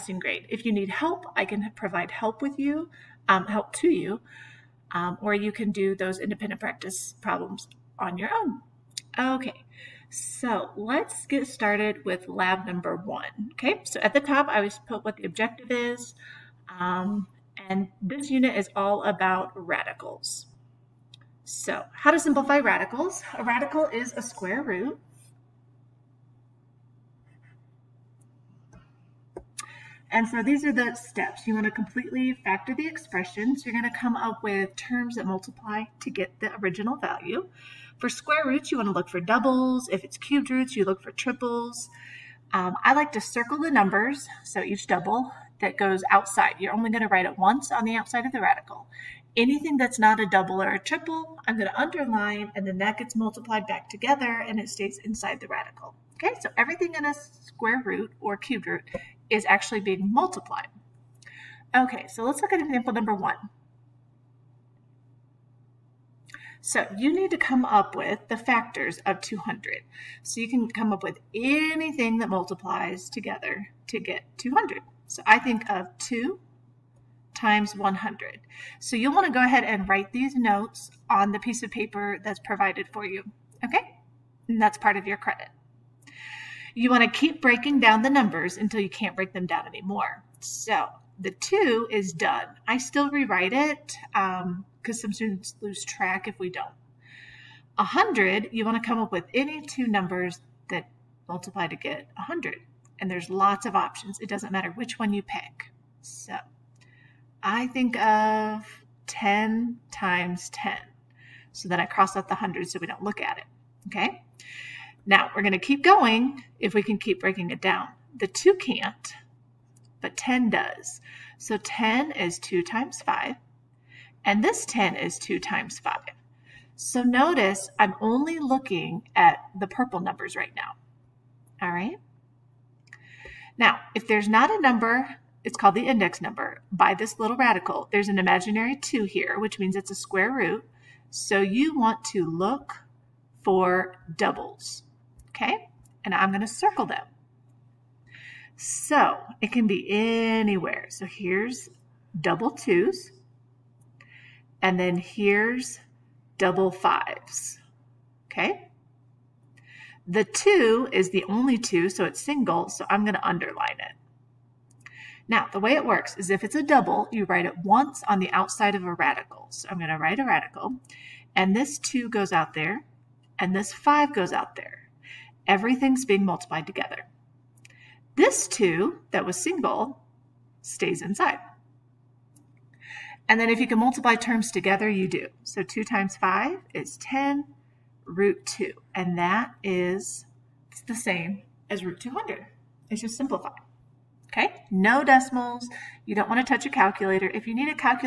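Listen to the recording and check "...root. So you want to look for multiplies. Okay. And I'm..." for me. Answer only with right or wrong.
wrong.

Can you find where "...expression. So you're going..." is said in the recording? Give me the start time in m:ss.
0:32.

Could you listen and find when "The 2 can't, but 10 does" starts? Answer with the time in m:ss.
1:58.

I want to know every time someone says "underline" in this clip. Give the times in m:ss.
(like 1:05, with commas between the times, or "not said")
0:51, 2:43.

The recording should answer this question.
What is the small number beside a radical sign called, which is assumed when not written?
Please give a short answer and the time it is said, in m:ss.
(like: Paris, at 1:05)
index number, at 2:15.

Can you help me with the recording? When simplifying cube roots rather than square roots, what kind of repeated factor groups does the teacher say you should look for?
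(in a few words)
triples.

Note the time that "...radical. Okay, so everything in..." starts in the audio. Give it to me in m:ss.
0:55.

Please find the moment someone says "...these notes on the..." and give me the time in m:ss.
1:20.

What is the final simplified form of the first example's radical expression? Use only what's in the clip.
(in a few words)
10 root 2.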